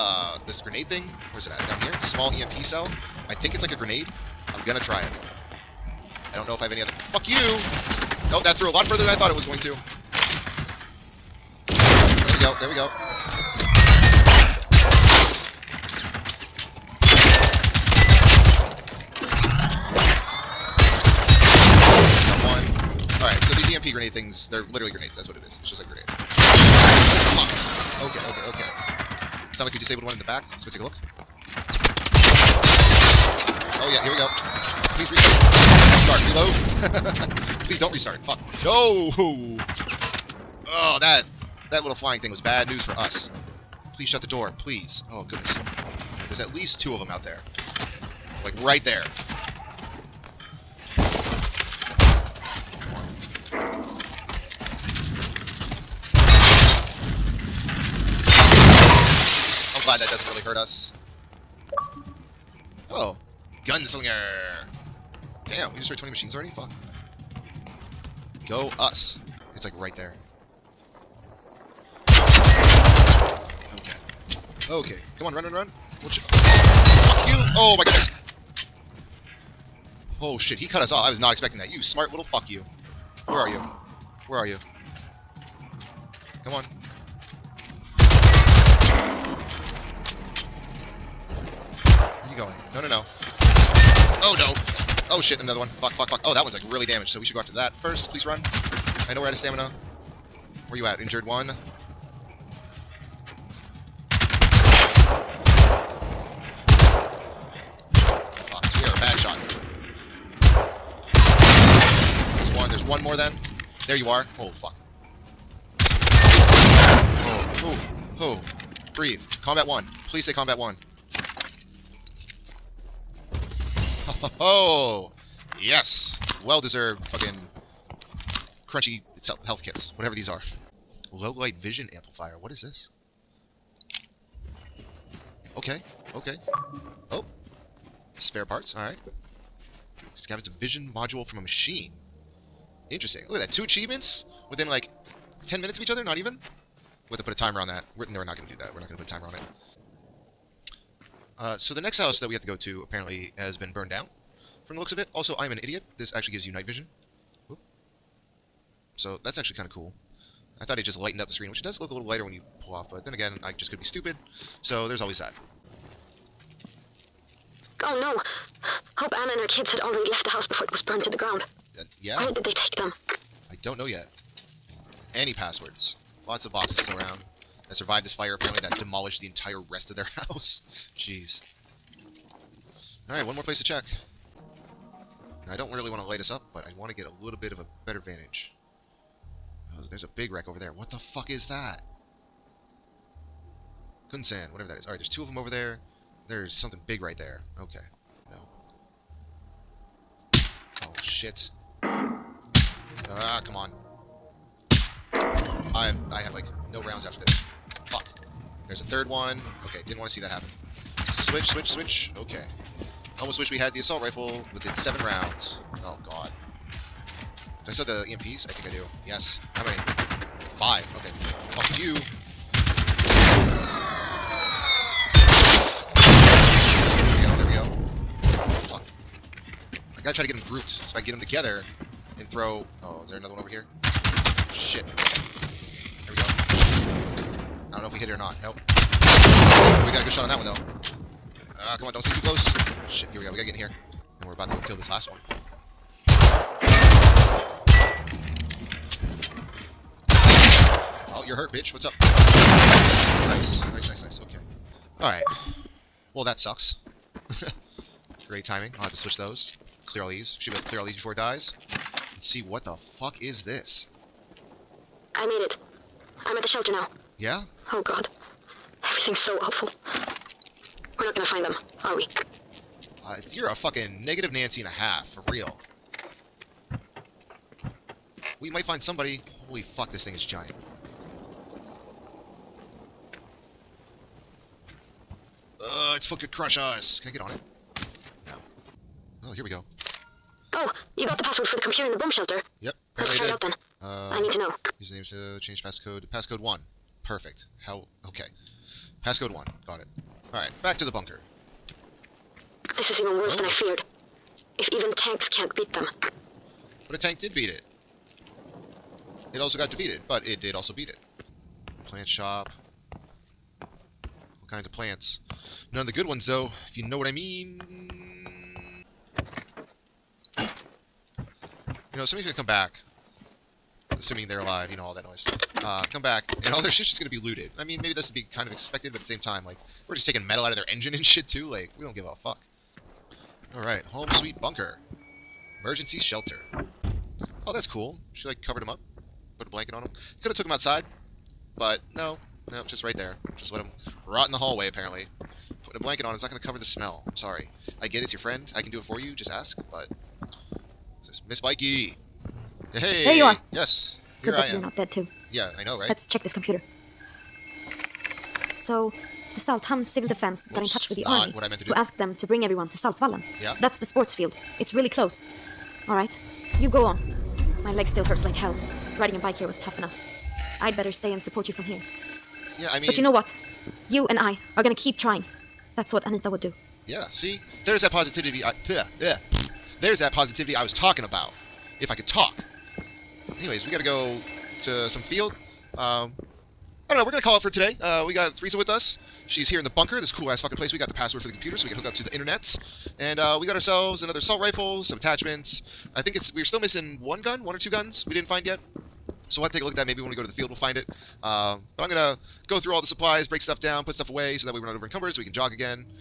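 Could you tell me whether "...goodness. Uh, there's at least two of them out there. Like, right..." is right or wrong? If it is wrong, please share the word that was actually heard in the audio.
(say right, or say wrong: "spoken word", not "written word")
right.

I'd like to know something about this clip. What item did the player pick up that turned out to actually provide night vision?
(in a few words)
Low light vision amplifier.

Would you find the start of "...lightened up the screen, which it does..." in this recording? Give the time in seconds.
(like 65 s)
160 s.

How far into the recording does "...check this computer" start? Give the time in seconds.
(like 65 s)
356 s.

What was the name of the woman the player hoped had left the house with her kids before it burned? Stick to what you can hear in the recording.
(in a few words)
Anna.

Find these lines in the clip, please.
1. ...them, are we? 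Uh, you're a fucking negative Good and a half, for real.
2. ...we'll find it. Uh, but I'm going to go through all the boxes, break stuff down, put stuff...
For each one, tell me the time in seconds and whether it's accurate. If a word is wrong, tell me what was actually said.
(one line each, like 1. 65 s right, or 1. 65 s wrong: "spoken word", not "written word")
1. 271 s wrong: "Nancy", not "Good"
2. 400 s wrong: "supplies", not "boxes".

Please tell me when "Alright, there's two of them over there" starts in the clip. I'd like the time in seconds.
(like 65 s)
194 s.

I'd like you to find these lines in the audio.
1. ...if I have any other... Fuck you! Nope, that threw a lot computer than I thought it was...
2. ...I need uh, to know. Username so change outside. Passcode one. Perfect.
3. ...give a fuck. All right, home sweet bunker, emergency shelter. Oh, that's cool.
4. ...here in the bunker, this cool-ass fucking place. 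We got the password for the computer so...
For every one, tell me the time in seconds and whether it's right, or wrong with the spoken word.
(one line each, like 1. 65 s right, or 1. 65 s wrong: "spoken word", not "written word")
1. 6 s wrong: "further", not "computer"
2. 294 s wrong: "passcode", not "outside"
3. 331 s right
4. 389 s right.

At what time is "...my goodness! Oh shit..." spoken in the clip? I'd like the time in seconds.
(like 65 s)
77 s.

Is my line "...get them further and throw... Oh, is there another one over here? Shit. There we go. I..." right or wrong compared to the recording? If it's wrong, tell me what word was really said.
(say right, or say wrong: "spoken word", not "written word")
wrong: "together", not "further".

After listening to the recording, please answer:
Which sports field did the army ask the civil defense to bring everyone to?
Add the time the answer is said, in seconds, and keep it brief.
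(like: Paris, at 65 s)
Saltvallen, at 362 s.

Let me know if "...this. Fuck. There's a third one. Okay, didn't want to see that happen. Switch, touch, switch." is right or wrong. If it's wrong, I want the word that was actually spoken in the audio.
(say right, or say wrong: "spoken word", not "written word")
wrong: "switch", not "touch".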